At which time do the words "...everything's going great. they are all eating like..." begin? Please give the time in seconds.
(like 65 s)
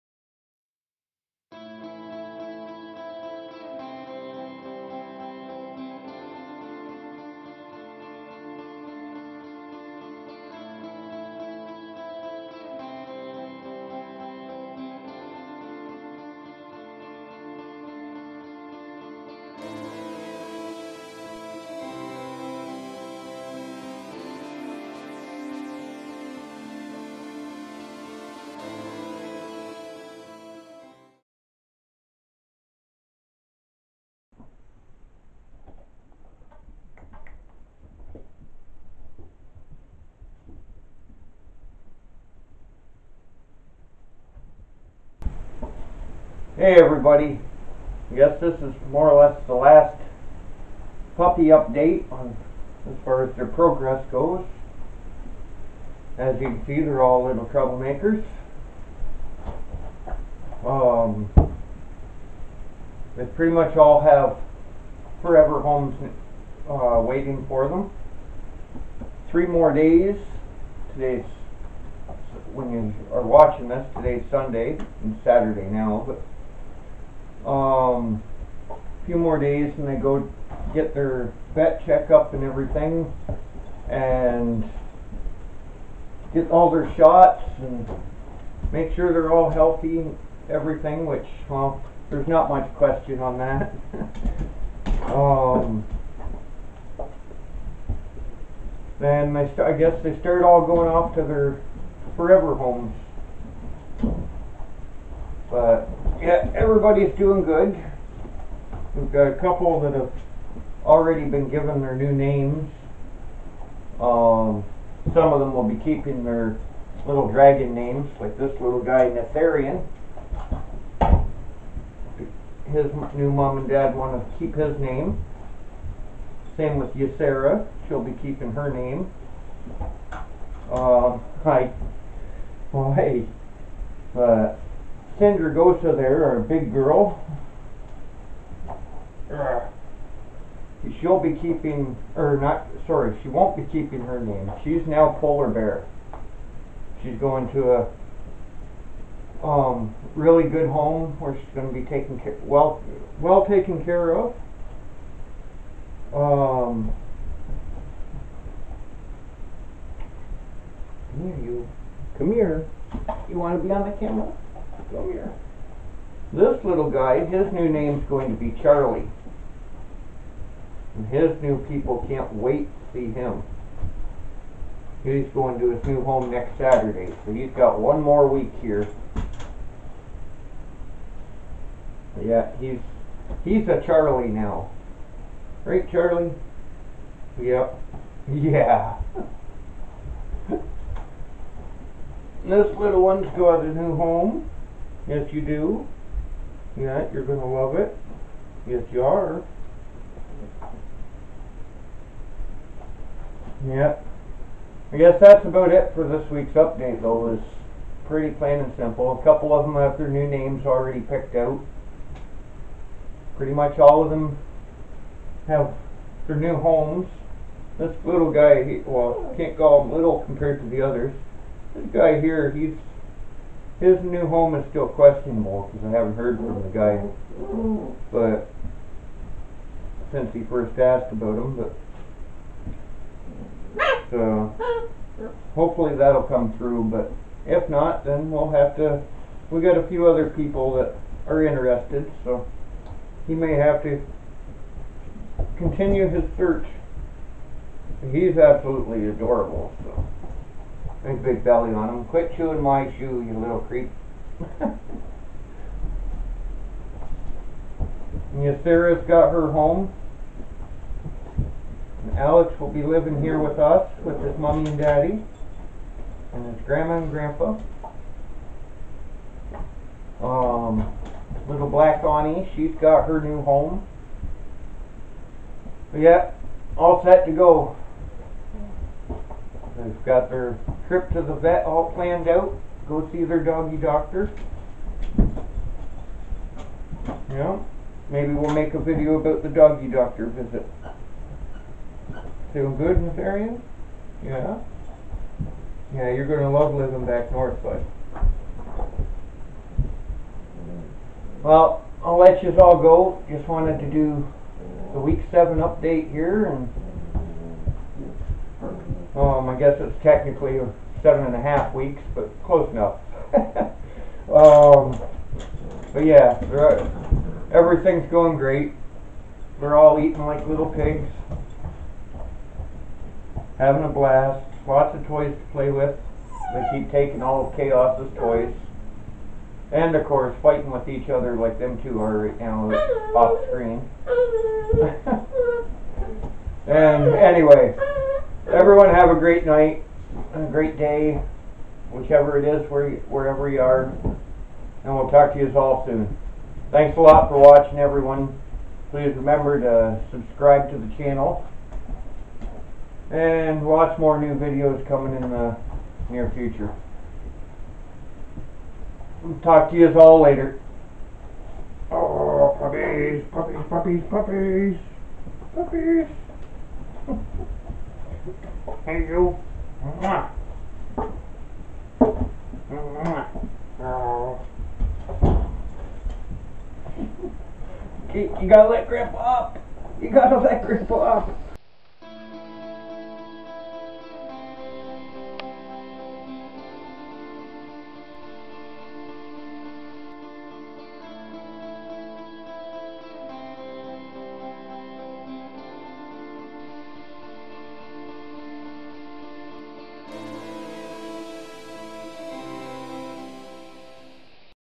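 317 s.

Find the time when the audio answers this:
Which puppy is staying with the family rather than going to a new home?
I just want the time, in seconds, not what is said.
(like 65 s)
262 s.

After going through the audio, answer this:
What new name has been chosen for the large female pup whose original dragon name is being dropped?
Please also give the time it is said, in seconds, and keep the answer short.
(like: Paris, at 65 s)
Polar Bear, at 145 s.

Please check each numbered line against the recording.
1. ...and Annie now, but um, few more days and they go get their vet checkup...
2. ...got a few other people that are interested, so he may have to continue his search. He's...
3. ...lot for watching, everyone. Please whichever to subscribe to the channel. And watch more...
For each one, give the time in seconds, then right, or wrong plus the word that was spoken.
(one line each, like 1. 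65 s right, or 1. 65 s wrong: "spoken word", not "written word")
1. 75 s wrong: "Saturday", not "Annie"
2. 239 s right
3. 347 s wrong: "remember", not "whichever".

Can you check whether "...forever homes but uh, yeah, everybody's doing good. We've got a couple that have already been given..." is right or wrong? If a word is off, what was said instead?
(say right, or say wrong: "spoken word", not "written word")
right.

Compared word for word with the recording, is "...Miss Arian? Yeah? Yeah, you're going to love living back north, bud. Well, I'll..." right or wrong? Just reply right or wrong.
right.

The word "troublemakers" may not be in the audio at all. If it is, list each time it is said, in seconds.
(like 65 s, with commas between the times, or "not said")
57 s.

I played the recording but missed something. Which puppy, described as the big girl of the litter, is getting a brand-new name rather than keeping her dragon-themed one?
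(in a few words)
Sindragosa.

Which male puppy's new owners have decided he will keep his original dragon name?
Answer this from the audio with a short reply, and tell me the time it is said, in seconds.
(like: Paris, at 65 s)
Neltharion, at 119 s.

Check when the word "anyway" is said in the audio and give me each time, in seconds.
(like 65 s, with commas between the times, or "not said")
337 s.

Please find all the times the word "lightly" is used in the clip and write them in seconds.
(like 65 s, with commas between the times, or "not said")
not said.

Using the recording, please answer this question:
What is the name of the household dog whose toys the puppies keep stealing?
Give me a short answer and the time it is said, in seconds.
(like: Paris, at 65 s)
Chaos, at 327 s.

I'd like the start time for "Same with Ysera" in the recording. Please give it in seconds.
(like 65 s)
126 s.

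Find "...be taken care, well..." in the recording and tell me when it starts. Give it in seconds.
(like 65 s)
151 s.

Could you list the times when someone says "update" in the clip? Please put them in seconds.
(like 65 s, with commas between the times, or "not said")
51 s, 206 s, 305 s.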